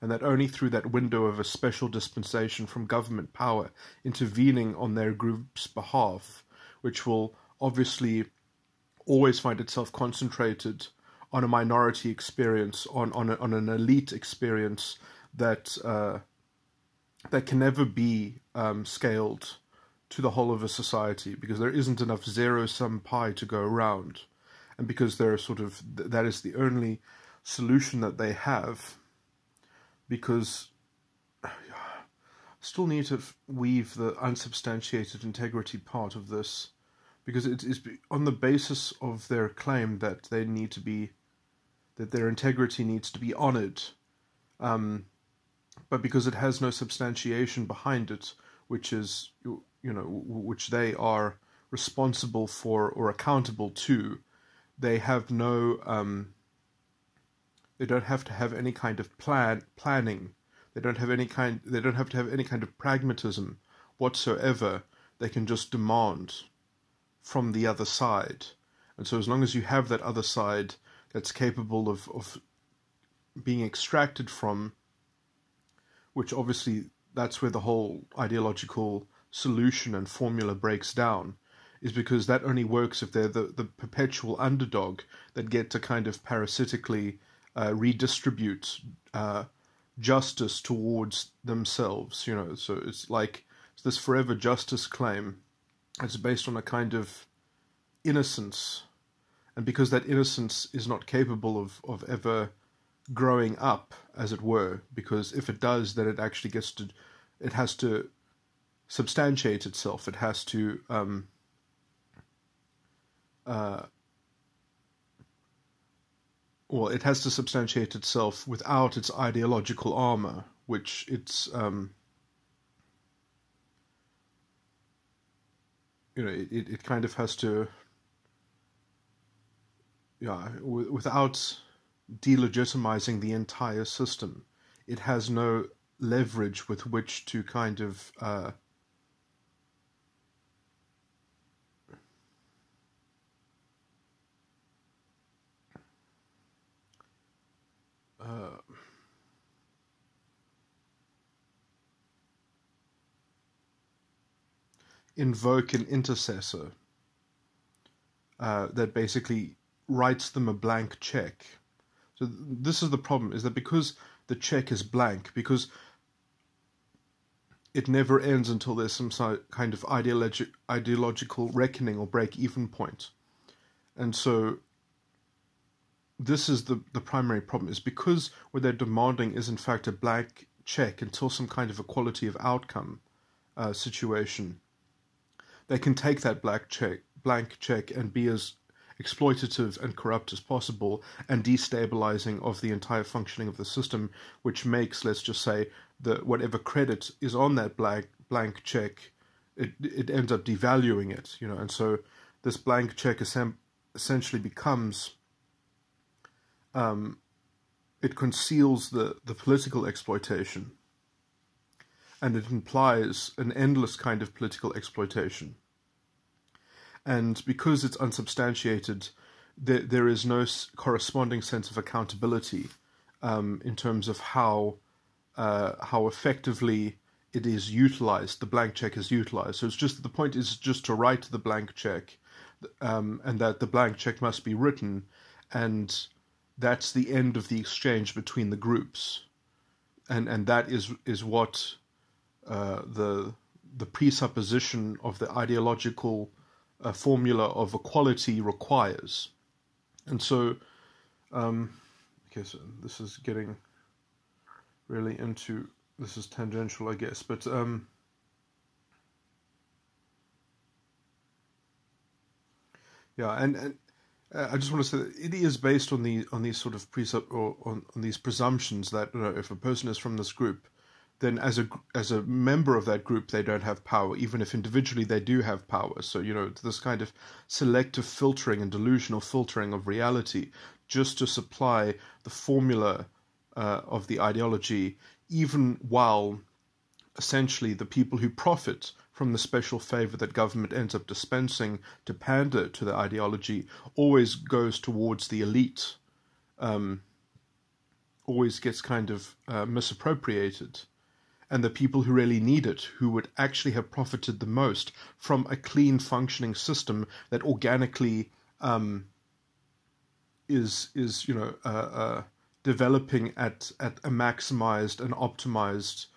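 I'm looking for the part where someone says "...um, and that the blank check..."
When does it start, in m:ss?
3:52.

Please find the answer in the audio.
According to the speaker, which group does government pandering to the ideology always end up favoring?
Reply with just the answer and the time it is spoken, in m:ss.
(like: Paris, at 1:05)
the elite, at 4:55.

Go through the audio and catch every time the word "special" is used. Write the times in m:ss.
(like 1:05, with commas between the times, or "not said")
0:01, 4:49.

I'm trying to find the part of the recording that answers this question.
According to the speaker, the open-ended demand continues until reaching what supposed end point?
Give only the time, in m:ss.
3:01.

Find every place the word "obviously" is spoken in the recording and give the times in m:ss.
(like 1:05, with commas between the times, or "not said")
0:07, 1:16.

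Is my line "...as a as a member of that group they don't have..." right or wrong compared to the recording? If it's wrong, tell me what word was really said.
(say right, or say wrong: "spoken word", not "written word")
right.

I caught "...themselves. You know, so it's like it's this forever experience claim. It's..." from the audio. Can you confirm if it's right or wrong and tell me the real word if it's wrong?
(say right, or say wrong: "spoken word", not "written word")
wrong: "justice", not "experience".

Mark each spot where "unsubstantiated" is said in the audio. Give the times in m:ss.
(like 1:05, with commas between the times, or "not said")
0:34, 3:37.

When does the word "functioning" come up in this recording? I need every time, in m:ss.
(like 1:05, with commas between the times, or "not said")
3:13, 5:05.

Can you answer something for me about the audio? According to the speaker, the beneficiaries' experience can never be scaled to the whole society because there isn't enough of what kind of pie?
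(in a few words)
zero sum pie.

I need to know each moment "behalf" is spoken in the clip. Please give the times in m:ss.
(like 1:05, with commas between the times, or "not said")
0:05.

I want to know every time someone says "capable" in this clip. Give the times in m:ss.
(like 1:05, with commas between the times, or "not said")
1:11, 1:41.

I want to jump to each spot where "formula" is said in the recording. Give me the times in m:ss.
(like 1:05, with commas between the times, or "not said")
1:20, 4:06, 4:42.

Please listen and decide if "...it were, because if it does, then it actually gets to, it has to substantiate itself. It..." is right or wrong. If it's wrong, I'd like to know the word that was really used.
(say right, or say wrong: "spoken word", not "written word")
right.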